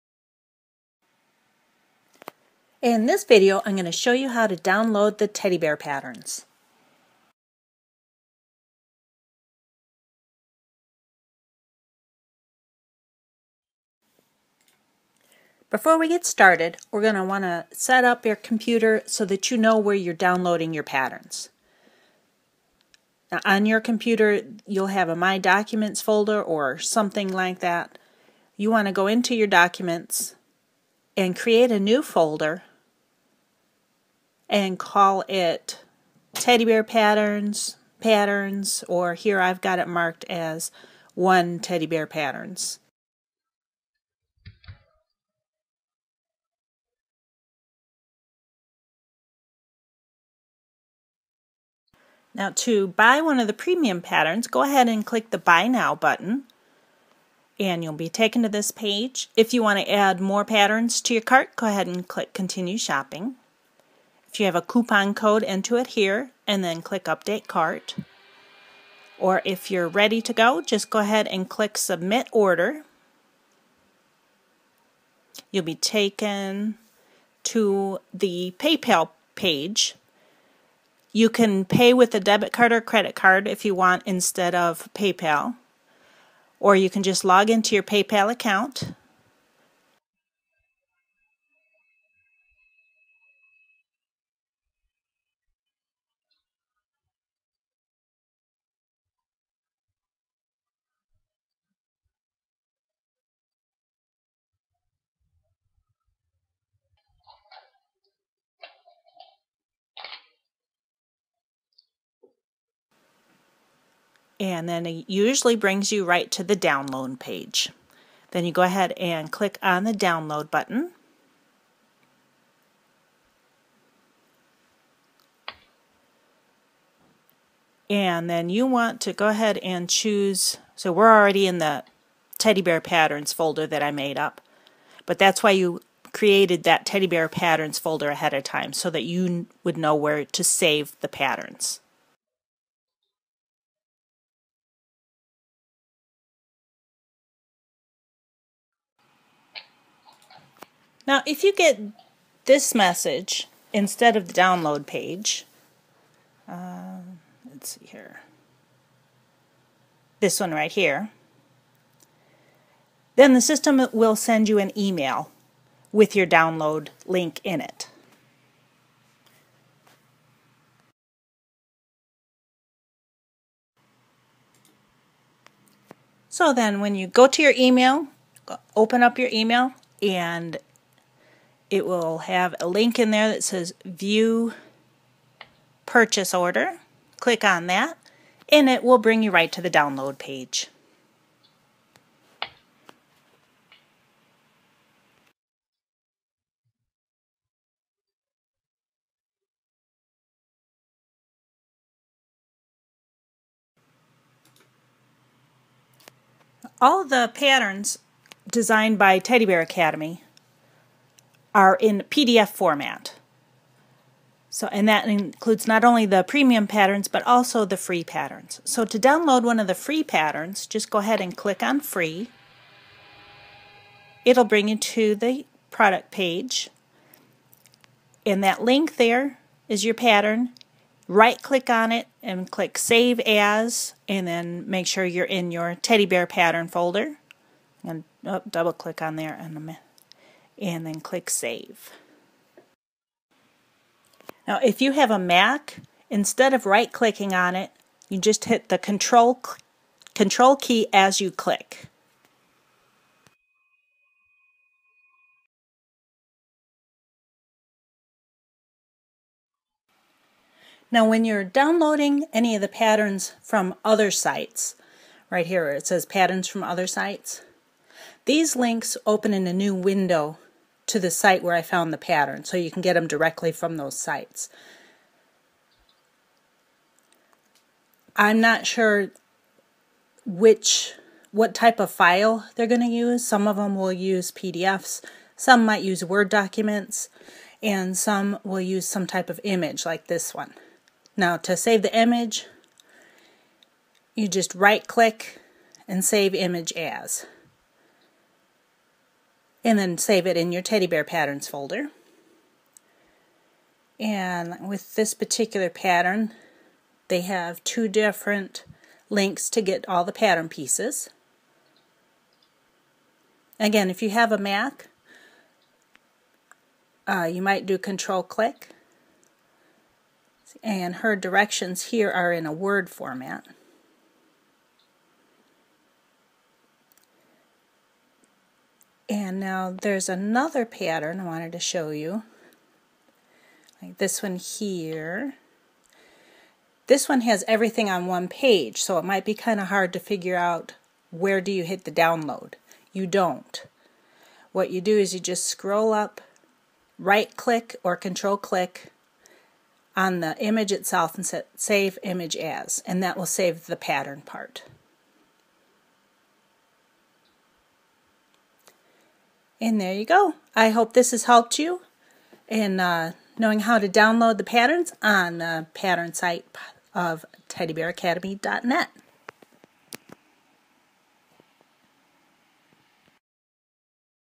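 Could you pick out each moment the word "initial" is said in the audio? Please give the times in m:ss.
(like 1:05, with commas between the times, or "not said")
not said.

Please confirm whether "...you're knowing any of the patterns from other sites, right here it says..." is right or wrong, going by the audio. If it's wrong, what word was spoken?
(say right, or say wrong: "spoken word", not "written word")
wrong: "downloading", not "knowing".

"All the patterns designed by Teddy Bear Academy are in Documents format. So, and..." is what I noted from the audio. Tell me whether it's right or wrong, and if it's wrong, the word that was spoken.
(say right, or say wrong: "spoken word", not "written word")
wrong: "PDF", not "Documents".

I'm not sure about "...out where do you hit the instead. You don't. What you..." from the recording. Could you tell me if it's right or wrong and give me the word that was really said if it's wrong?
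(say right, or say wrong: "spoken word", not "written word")
wrong: "download", not "instead".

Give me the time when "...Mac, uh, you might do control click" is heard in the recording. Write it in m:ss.
5:14.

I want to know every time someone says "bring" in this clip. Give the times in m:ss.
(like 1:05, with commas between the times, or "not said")
1:55, 3:08, 3:44.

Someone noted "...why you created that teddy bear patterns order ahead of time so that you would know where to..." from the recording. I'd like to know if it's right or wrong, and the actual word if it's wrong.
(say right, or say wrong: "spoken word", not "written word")
wrong: "folder", not "order".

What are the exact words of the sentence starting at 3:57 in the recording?
And oh, double click on there in a minute and then click Save.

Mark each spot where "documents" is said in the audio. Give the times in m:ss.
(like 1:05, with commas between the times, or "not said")
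0:25, 0:29, 4:46.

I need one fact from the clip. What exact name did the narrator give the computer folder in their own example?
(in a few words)
one teddy bear patterns.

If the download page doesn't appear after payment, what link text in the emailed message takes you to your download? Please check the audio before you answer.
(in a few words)
view purchase order.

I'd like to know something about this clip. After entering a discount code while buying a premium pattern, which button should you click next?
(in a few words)
Update Cart.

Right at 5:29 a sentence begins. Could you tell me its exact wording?
And now there's another pattern I wanted to show you.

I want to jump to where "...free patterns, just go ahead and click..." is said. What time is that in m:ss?
3:39.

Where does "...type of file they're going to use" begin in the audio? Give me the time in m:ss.
4:41.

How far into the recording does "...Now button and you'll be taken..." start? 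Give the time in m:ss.
0:55.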